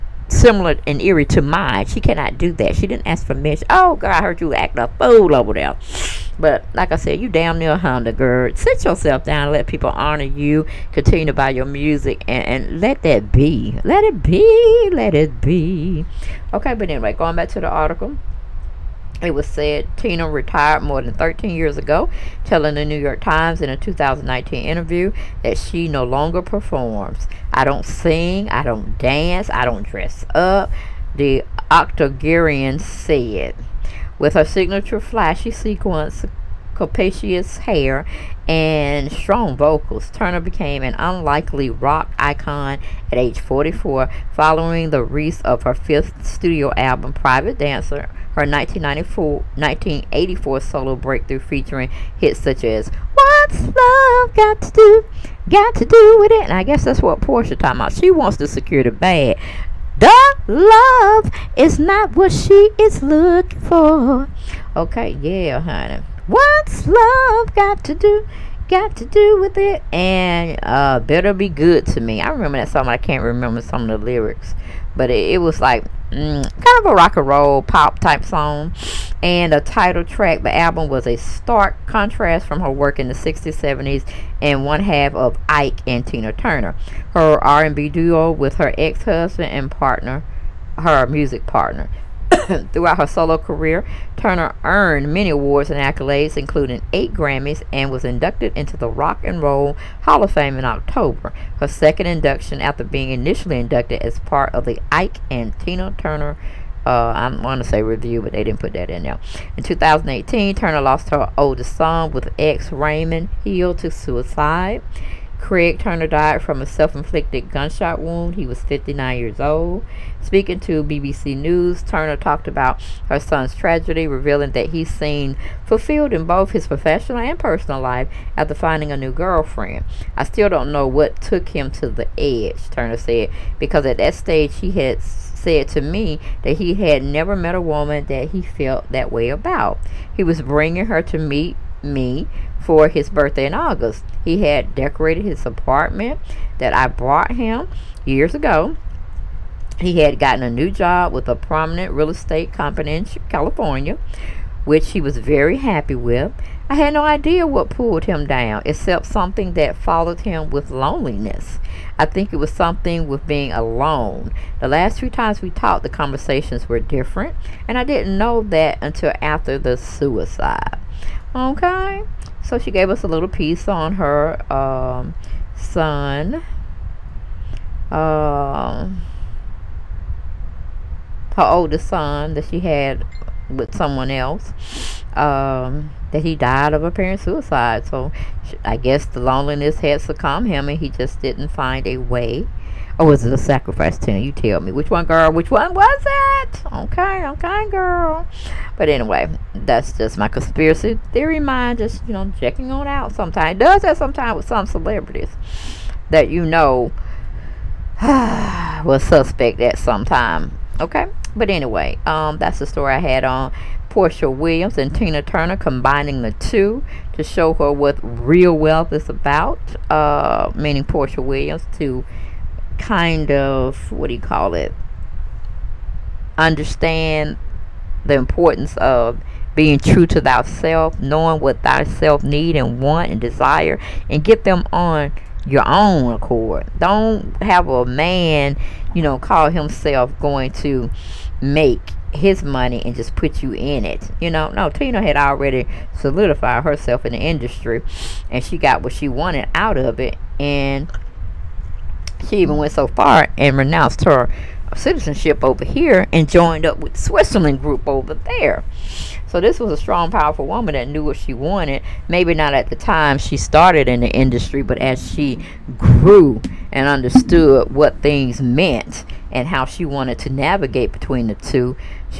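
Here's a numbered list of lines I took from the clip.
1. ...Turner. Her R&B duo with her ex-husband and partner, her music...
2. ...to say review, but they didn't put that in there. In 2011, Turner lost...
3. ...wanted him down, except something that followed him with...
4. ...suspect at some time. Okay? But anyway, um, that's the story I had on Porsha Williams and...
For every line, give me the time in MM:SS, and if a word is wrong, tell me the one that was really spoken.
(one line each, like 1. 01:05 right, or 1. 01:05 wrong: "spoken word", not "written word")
1. 01:26 right
2. 01:47 wrong: "2018", not "2011"
3. 02:37 wrong: "pulled", not "wanted"
4. 03:29 right.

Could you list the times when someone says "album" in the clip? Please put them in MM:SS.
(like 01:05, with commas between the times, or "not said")
00:46, 01:20.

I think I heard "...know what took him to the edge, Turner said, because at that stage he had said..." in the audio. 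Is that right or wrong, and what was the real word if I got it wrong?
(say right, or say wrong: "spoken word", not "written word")
right.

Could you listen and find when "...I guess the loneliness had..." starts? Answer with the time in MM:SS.
03:08.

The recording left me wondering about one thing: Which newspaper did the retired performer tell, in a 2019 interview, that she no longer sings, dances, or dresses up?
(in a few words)
The New York Times.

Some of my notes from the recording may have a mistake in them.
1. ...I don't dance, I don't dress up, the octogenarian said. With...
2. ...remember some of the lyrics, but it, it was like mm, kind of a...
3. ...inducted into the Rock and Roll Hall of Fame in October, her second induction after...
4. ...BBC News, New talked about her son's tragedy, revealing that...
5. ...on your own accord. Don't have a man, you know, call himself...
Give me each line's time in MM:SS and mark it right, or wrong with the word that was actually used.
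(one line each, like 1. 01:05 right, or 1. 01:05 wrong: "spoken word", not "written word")
1. 00:28 right
2. 01:13 right
3. 01:38 right
4. 02:00 wrong: "Turner", not "New"
5. 03:54 right.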